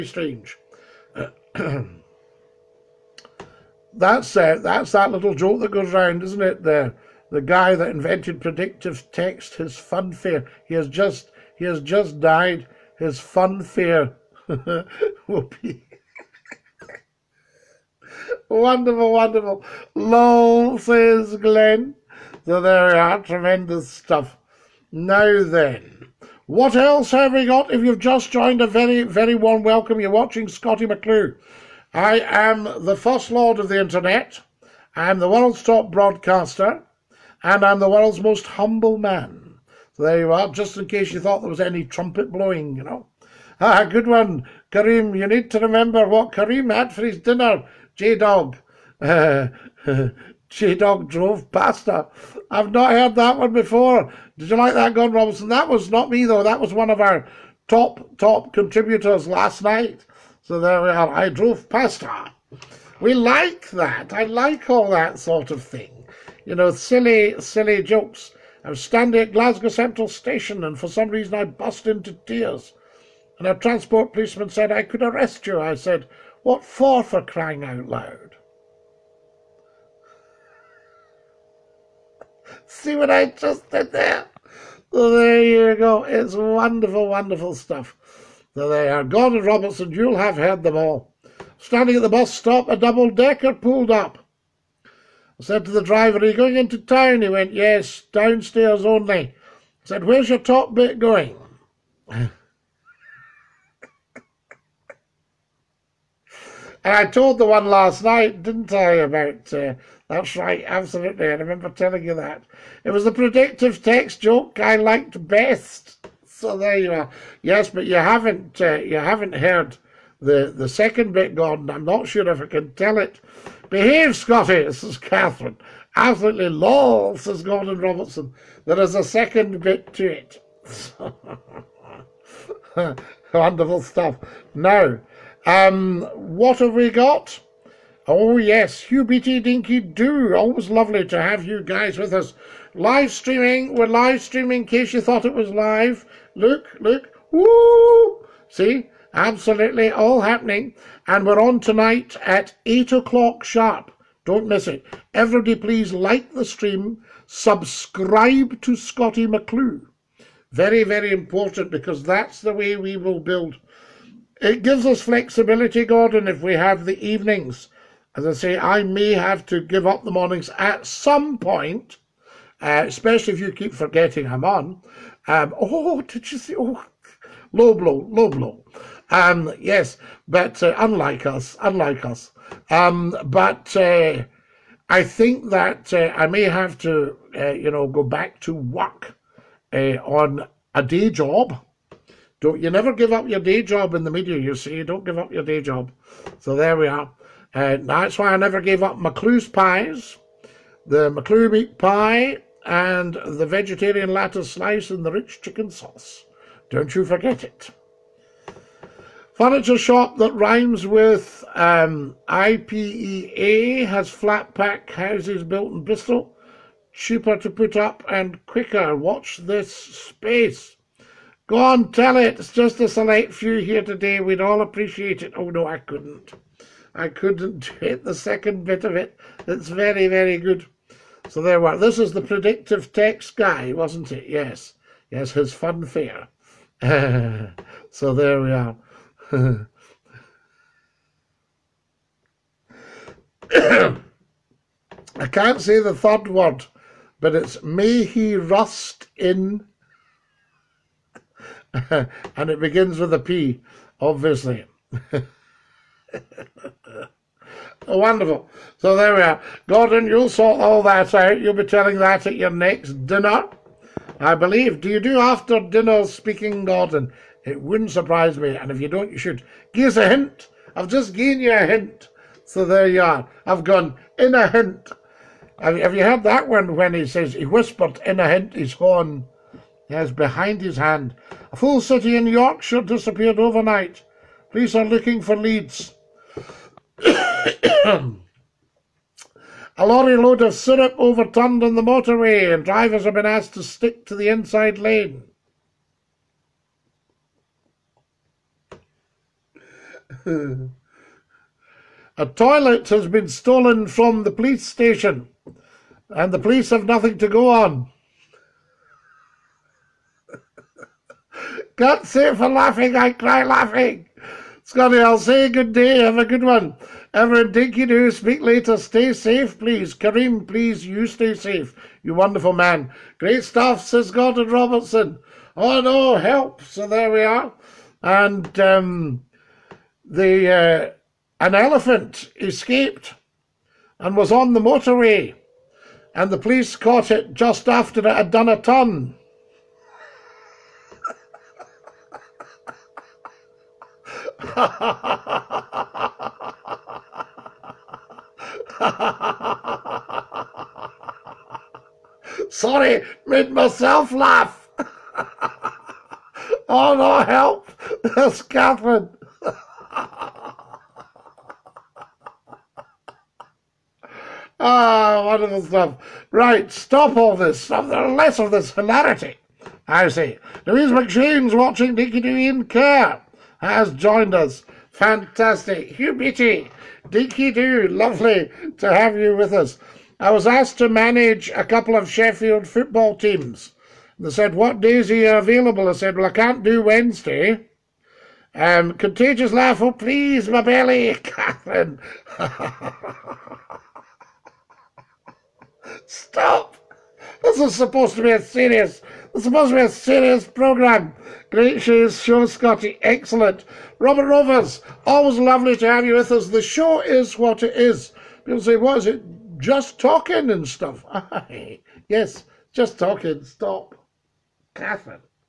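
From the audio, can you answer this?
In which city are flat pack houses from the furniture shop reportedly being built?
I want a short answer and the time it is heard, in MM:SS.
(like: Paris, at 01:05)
Bristol, at 03:35.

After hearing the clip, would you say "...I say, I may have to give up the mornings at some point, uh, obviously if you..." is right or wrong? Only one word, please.
wrong.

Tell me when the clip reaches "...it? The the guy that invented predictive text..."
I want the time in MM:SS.
00:06.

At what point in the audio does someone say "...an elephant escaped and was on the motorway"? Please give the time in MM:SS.
05:31.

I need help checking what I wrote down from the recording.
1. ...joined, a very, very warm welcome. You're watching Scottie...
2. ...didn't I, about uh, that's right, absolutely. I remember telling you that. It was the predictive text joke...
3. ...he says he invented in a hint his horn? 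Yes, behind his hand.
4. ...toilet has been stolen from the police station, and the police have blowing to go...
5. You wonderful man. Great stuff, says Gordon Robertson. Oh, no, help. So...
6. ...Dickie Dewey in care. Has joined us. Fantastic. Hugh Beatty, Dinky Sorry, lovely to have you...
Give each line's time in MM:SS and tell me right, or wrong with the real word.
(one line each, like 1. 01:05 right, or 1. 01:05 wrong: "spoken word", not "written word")
1. 00:28 right
2. 01:48 right
3. 04:36 wrong: "whispered", not "invented"
4. 05:02 wrong: "nothing", not "blowing"
5. 05:22 right
6. 06:11 wrong: "Doo", not "Sorry".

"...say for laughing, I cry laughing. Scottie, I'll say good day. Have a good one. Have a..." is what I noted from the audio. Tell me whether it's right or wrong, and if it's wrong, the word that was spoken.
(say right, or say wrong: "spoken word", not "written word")
right.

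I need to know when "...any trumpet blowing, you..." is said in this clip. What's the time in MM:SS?
00:41.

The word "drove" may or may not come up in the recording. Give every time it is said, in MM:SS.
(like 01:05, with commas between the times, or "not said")
00:51, 01:01.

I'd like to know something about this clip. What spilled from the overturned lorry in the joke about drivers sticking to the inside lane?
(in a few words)
syrup.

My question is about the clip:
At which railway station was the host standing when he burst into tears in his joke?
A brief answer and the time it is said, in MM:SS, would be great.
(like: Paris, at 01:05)
Glasgow Central Station, at 01:09.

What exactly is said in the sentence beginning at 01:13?
And a transport policeman said, I could arrest you.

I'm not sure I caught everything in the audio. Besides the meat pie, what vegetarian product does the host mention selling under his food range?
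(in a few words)
vegetarian lettuce slice.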